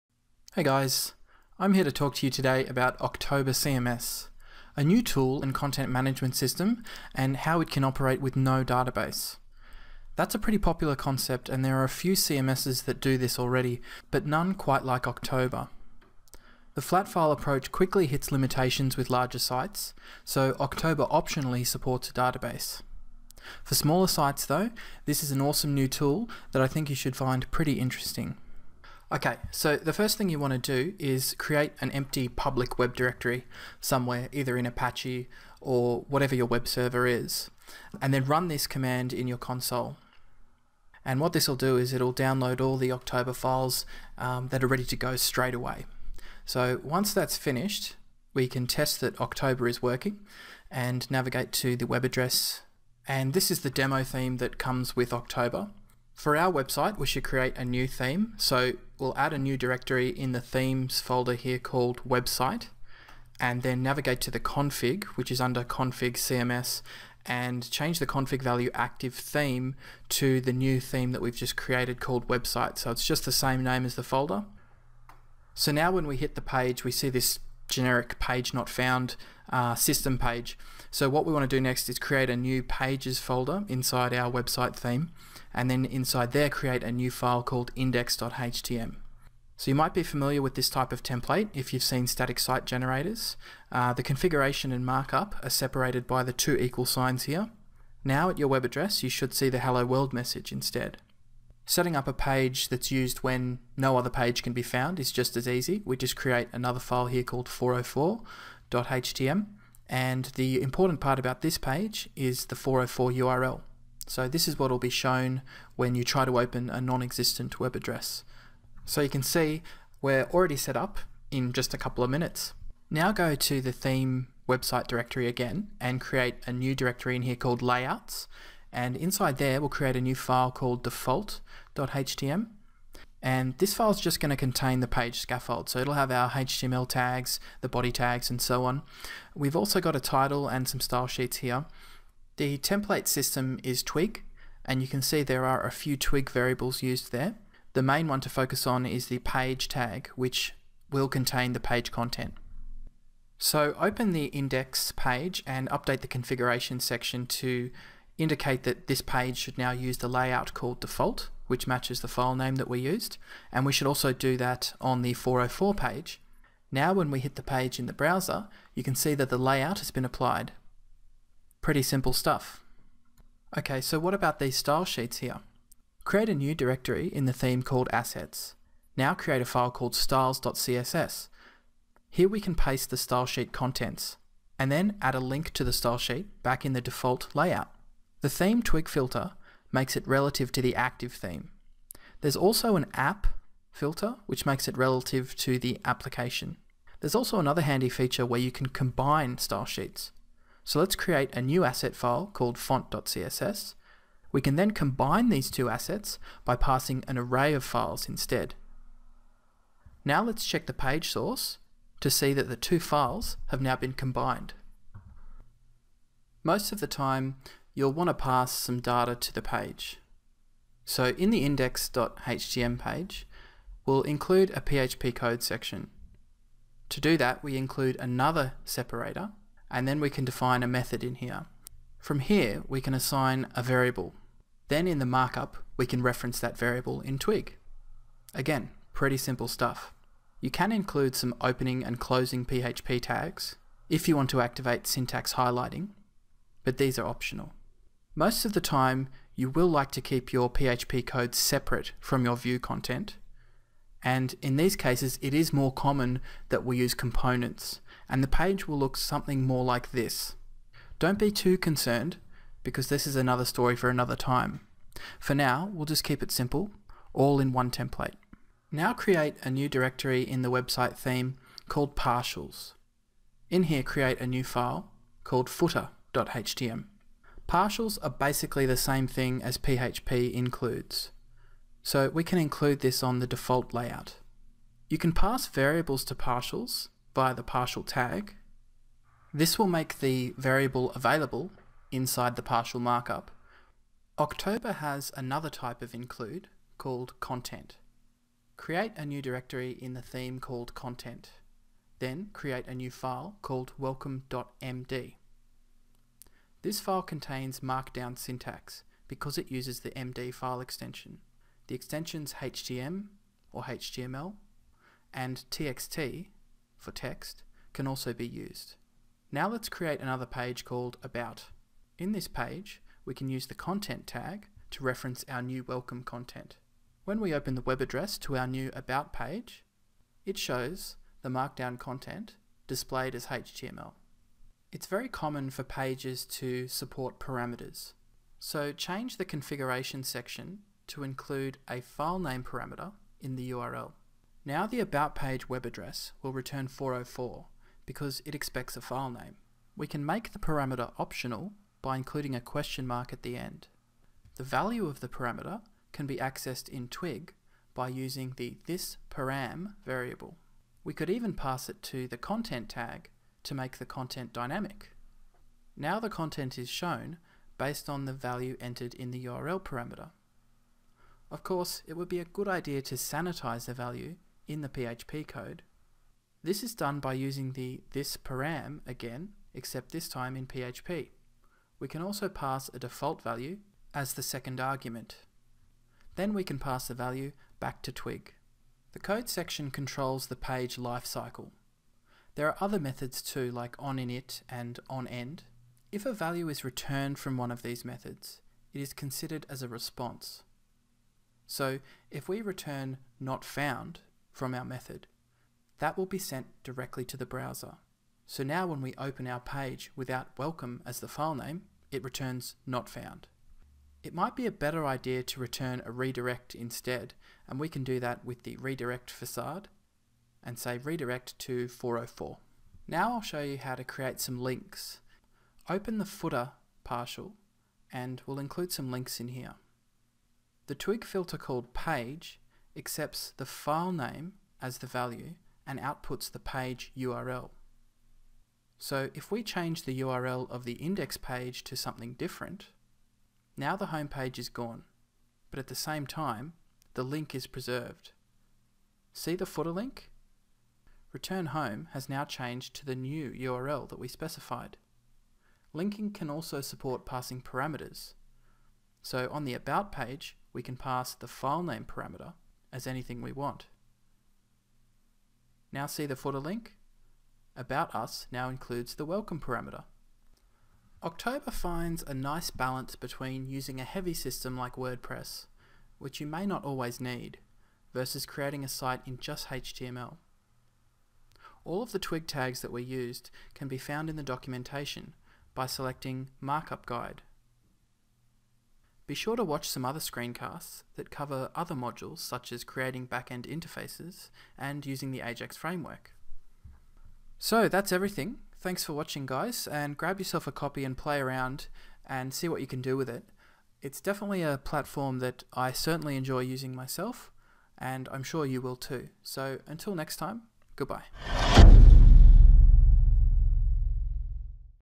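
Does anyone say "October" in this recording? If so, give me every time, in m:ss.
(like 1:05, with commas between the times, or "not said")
0:02, 0:15, 0:20, 0:42, 0:49, 0:55, 4:54, 7:51.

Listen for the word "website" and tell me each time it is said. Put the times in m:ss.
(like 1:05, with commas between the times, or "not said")
0:56, 1:02, 1:12, 1:24, 2:04, 4:30.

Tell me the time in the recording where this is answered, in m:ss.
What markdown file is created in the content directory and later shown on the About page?
5:03.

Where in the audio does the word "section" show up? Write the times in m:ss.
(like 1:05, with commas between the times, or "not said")
2:36, 3:45, 5:40, 6:29.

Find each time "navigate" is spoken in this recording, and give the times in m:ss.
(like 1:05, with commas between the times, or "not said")
0:51, 1:03.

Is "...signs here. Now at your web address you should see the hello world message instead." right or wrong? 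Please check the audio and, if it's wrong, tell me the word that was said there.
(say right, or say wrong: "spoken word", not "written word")
right.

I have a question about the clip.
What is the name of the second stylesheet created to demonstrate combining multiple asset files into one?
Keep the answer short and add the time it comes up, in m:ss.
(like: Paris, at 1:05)
font.css, at 3:22.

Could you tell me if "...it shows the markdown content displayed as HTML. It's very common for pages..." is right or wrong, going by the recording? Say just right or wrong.
right.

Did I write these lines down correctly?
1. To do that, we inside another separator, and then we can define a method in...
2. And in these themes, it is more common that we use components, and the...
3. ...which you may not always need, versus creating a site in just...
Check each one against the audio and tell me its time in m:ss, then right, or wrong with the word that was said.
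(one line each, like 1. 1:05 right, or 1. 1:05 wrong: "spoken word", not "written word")
1. 3:46 wrong: "include", not "inside"
2. 4:14 wrong: "cases", not "themes"
3. 7:55 right.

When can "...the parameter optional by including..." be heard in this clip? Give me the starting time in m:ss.
5:50.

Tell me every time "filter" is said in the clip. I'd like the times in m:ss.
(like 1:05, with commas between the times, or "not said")
3:08, 3:13, 7:11.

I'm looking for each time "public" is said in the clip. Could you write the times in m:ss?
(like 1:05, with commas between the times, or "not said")
0:32.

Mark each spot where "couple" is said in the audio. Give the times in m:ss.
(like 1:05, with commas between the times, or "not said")
2:01.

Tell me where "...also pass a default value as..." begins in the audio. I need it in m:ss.
6:22.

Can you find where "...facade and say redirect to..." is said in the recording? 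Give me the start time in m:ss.
6:59.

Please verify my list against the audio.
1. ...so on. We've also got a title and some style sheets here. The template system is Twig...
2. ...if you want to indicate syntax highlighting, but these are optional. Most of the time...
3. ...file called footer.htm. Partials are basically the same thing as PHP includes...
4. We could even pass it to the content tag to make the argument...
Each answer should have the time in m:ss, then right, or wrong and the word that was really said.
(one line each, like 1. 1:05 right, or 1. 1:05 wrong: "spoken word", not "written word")
1. 2:18 right
2. 4:03 wrong: "activate", not "indicate"
3. 4:34 right
4. 6:00 wrong: "content", not "argument".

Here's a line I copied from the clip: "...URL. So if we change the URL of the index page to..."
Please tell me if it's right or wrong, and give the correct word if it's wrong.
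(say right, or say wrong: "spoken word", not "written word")
right.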